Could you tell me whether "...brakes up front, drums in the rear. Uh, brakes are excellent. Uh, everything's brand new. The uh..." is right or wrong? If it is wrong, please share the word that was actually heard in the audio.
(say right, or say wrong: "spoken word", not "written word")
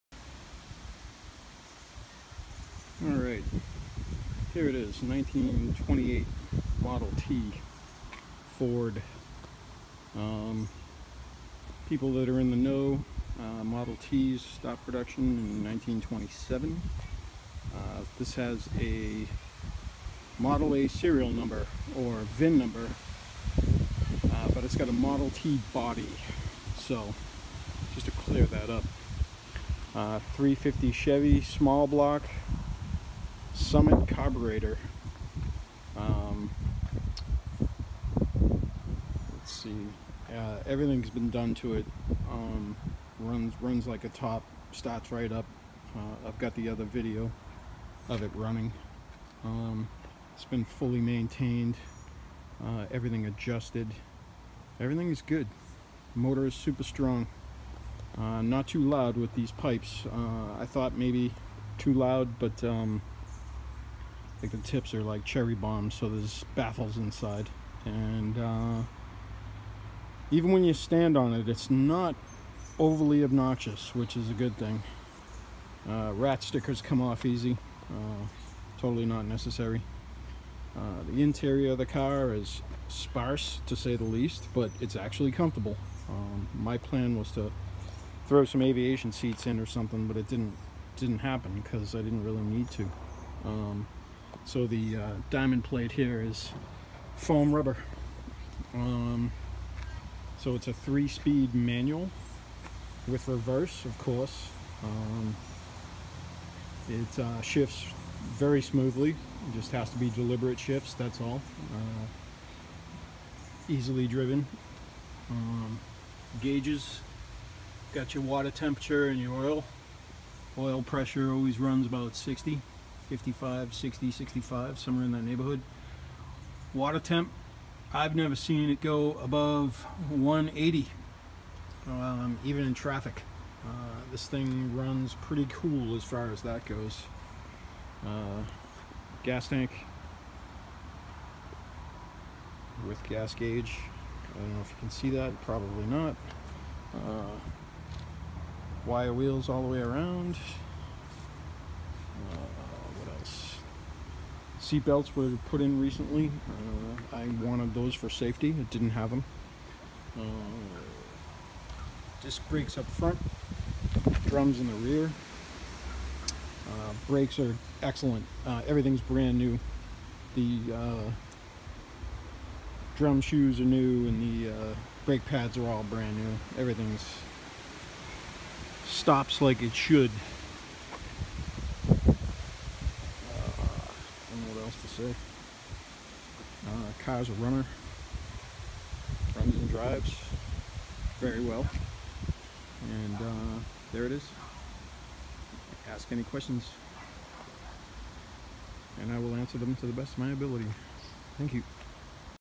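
right.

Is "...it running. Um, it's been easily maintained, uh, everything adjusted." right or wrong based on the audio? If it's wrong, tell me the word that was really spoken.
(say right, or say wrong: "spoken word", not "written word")
wrong: "fully", not "easily".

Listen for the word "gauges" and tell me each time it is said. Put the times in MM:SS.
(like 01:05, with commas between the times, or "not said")
01:56, 02:23.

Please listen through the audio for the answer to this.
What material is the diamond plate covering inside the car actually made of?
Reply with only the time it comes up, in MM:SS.
01:37.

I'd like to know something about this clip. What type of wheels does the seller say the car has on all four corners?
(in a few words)
Wire wheels.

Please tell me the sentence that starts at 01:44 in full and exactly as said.
Um, it uh, shifts very smoothly.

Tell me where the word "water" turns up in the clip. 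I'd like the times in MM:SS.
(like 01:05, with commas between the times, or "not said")
01:58, 02:06.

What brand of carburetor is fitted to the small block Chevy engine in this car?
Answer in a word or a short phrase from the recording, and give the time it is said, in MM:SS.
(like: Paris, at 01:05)
Summit, at 00:33.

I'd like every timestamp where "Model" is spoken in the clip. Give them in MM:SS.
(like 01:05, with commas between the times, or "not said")
00:06, 00:13, 00:20, 00:24.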